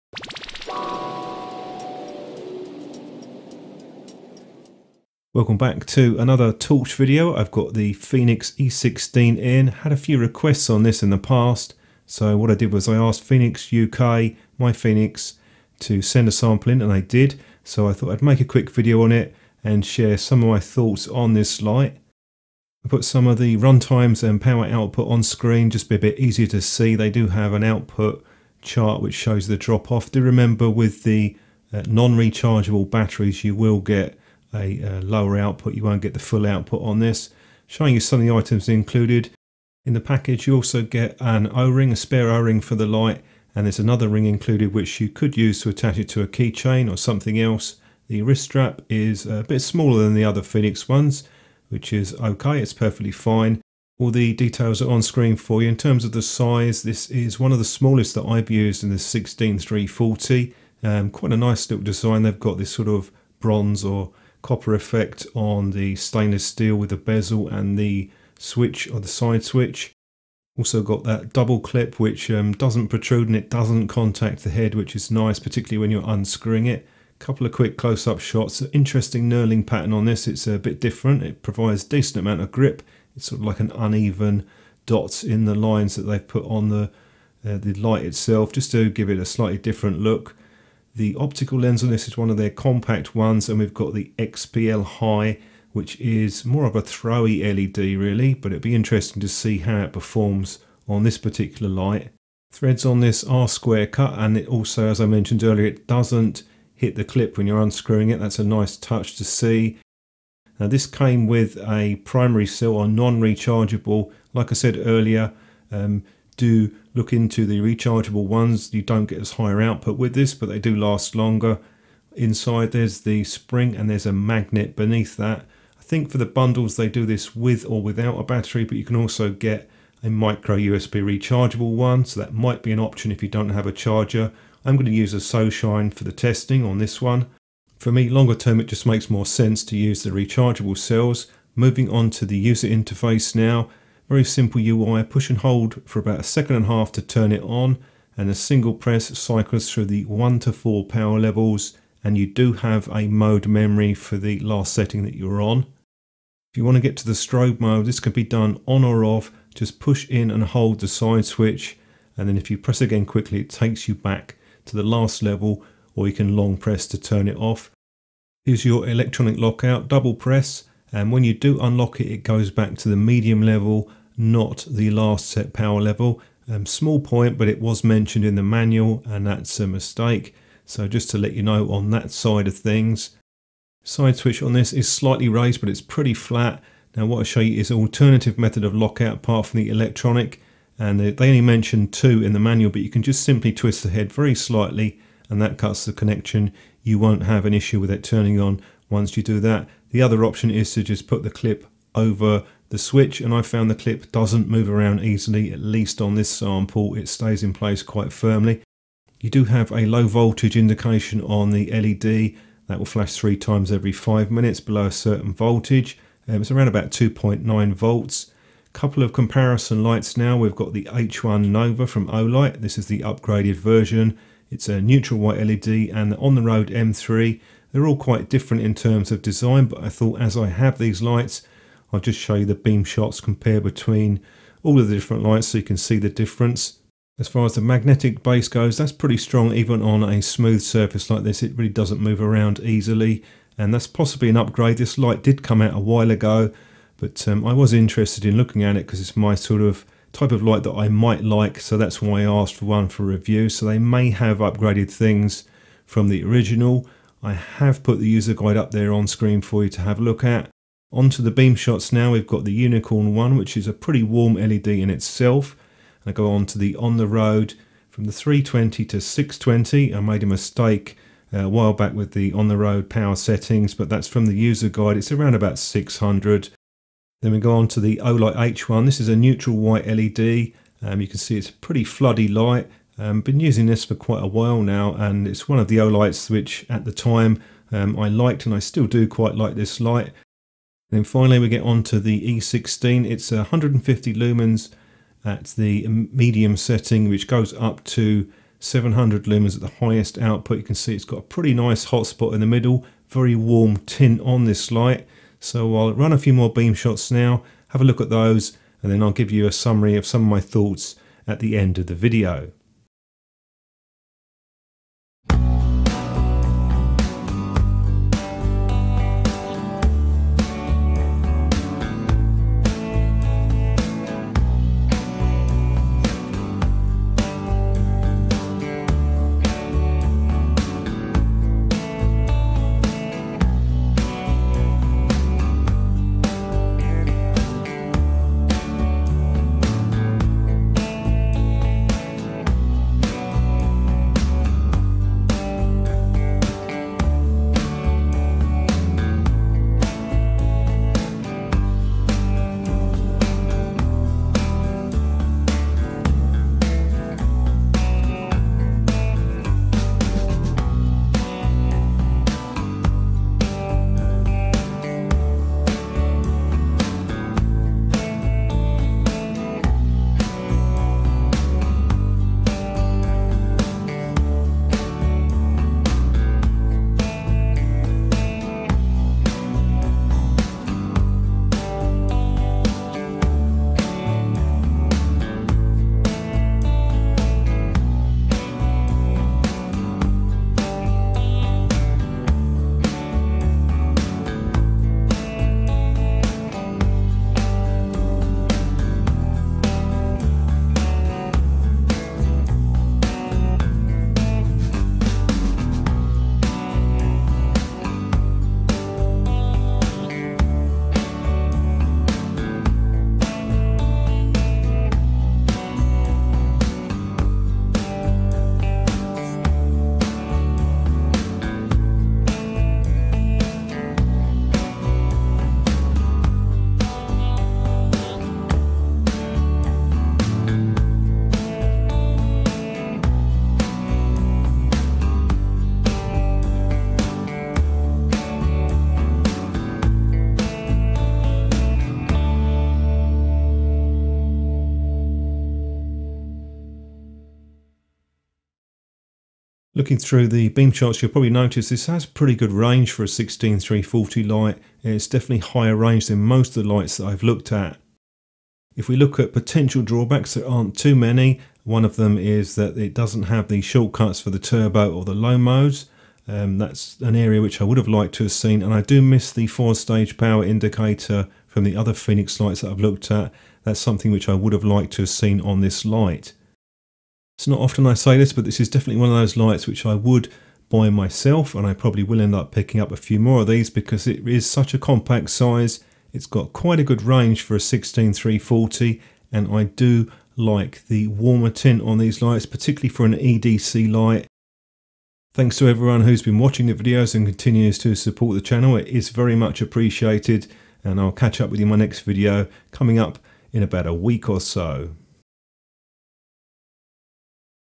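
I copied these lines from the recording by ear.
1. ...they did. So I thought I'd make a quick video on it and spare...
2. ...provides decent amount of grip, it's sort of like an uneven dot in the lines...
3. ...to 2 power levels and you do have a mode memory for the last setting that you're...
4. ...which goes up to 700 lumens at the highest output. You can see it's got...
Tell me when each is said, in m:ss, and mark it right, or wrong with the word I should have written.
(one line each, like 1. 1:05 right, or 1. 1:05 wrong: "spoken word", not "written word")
1. 0:16 wrong: "share", not "spare"
2. 1:21 right
3. 2:30 wrong: "4", not "2"
4. 4:57 right.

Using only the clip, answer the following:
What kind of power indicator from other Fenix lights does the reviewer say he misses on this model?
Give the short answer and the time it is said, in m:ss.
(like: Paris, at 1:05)
Four stage power indicator, at 7:49.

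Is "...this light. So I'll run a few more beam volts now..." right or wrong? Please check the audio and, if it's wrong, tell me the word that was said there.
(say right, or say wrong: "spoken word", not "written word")
wrong: "shots", not "volts".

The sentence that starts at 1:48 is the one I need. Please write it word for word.
That's a nice touch to see.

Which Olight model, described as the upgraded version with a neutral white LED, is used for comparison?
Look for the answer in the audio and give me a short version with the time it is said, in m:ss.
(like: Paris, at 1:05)
H1 Nova, at 3:40.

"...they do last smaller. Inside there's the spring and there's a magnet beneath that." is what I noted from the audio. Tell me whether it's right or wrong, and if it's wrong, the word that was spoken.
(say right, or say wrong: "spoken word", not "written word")
wrong: "longer", not "smaller".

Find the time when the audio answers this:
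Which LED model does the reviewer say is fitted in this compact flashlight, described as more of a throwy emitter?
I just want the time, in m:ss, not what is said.
1:34.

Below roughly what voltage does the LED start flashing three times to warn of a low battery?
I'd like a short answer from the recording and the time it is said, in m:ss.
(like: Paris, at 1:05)
2.9 volts, at 3:36.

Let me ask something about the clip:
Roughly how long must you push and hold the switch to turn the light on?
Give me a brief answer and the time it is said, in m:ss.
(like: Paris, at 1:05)
About a second and a half, at 2:25.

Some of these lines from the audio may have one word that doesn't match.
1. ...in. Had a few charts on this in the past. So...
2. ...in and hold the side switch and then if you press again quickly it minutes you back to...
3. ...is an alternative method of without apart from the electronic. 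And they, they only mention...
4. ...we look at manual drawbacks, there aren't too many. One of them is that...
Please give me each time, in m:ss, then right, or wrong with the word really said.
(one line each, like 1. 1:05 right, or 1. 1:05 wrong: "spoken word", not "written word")
1. 0:09 wrong: "requests", not "charts"
2. 2:40 wrong: "takes", not "minutes"
3. 3:07 wrong: "lockout", not "without"
4. 7:38 wrong: "potential", not "manual".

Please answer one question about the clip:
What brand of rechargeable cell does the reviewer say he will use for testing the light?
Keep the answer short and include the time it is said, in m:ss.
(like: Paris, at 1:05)
SoShine, at 2:15.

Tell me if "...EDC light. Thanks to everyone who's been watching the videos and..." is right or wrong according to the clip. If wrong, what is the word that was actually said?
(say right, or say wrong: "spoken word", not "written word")
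right.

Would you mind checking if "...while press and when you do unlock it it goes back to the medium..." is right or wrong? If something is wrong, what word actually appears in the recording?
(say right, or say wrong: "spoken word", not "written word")
wrong: "double", not "while".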